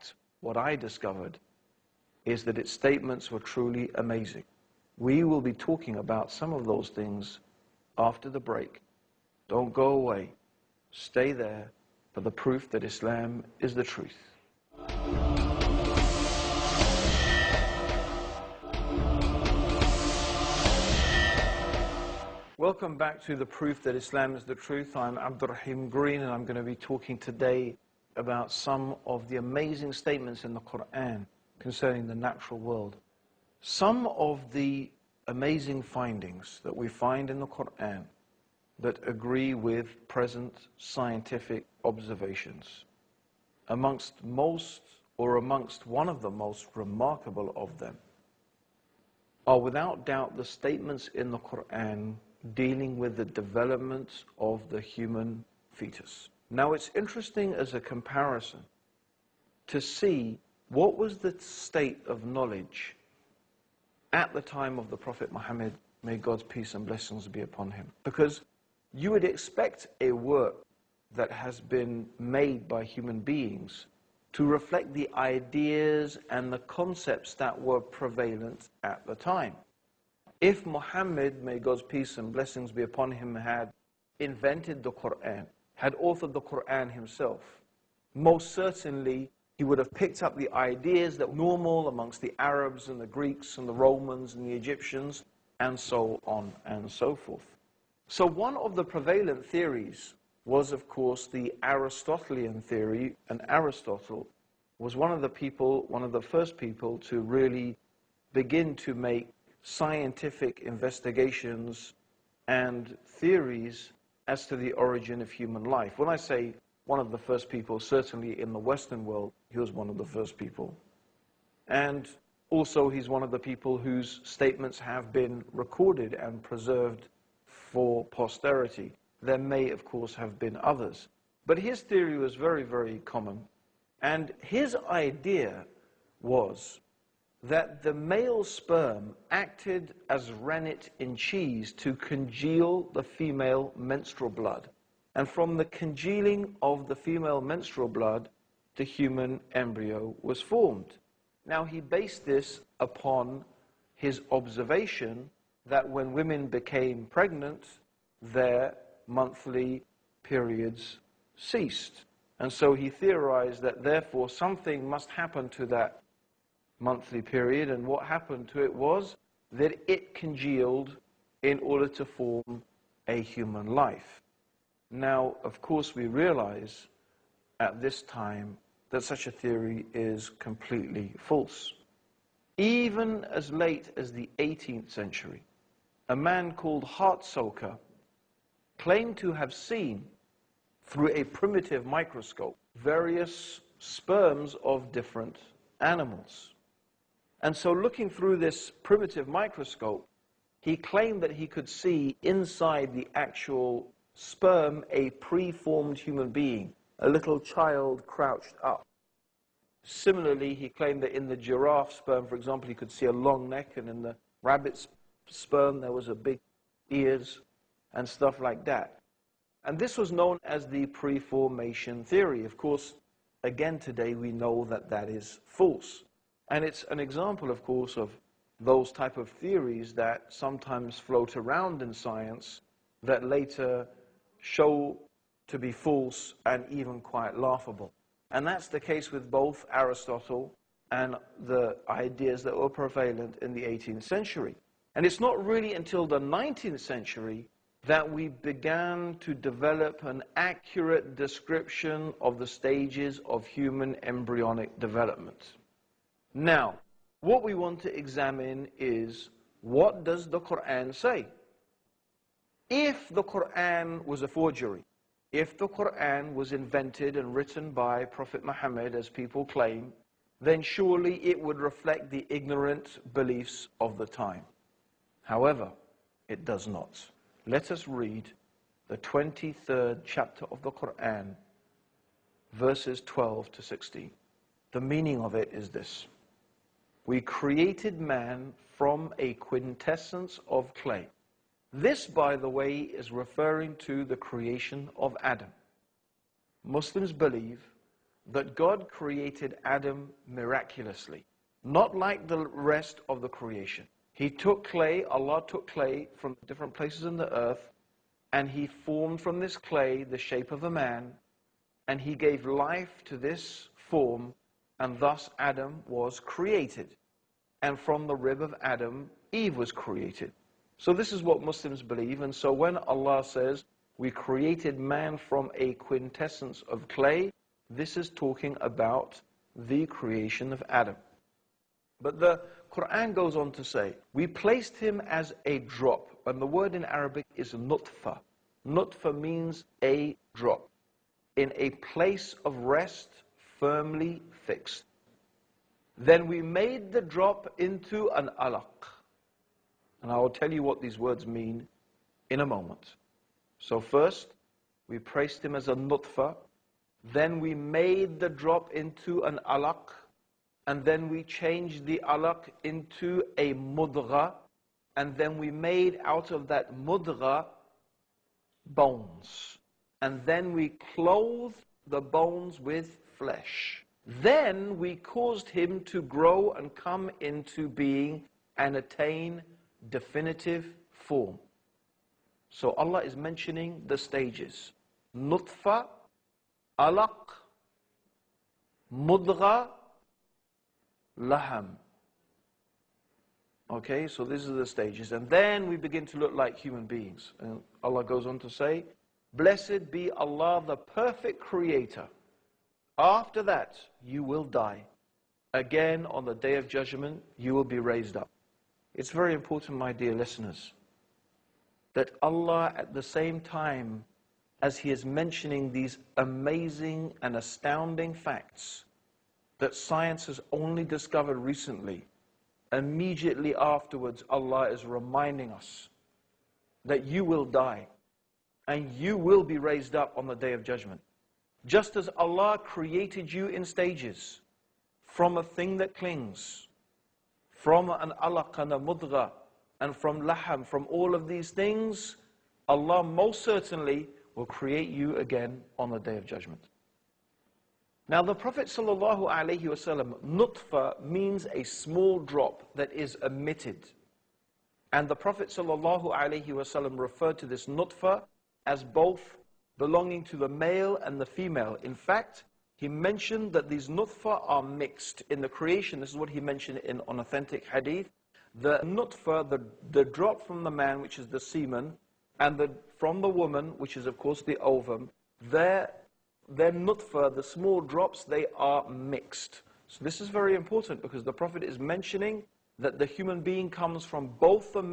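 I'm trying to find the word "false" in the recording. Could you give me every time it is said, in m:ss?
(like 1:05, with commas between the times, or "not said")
3:01, 3:45, 3:55.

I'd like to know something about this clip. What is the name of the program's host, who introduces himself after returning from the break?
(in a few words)
Abdur Raheem Green.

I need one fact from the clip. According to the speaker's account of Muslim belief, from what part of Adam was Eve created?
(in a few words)
the rib.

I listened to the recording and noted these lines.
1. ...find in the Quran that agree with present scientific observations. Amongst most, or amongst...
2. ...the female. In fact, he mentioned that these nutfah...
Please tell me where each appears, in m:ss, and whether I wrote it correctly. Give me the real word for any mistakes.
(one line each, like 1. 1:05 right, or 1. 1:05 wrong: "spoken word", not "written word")
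1. 0:36 right
2. 7:41 right.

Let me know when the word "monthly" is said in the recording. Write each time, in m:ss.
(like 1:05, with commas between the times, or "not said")
2:39, 2:46.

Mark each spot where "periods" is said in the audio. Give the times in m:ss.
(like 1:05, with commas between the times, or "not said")
2:40, 2:47.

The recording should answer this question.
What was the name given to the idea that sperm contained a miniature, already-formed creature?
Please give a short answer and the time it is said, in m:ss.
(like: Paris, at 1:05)
preformation theory, at 3:40.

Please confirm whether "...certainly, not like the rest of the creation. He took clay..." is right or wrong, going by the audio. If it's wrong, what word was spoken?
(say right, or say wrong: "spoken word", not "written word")
wrong: "miraculously", not "certainly".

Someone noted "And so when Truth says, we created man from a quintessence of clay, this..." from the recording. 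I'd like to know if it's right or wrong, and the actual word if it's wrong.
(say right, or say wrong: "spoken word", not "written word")
wrong: "Allah", not "Truth".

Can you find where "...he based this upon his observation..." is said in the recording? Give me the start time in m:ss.
2:31.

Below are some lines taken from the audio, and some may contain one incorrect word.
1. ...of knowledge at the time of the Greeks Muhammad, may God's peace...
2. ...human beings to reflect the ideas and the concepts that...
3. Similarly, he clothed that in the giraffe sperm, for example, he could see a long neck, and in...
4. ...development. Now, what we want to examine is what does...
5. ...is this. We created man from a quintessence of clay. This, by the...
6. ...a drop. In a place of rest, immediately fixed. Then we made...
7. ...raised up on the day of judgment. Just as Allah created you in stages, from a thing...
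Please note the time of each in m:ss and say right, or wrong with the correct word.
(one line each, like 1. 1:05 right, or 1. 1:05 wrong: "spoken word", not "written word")
1. 1:02 wrong: "Prophet", not "Greeks"
2. 1:12 right
3. 3:29 wrong: "claimed", not "clothed"
4. 4:14 right
5. 4:45 right
6. 5:39 wrong: "firmly", not "immediately"
7. 7:09 right.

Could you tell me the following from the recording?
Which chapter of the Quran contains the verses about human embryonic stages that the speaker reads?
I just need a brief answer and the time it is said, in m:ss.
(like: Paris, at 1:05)
23rd chapter, at 4:38.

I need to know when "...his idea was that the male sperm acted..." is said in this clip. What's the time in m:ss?
2:14.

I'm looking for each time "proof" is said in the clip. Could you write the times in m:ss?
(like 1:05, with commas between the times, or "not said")
0:12, 0:23.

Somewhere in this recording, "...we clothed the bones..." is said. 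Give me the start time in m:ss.
6:10.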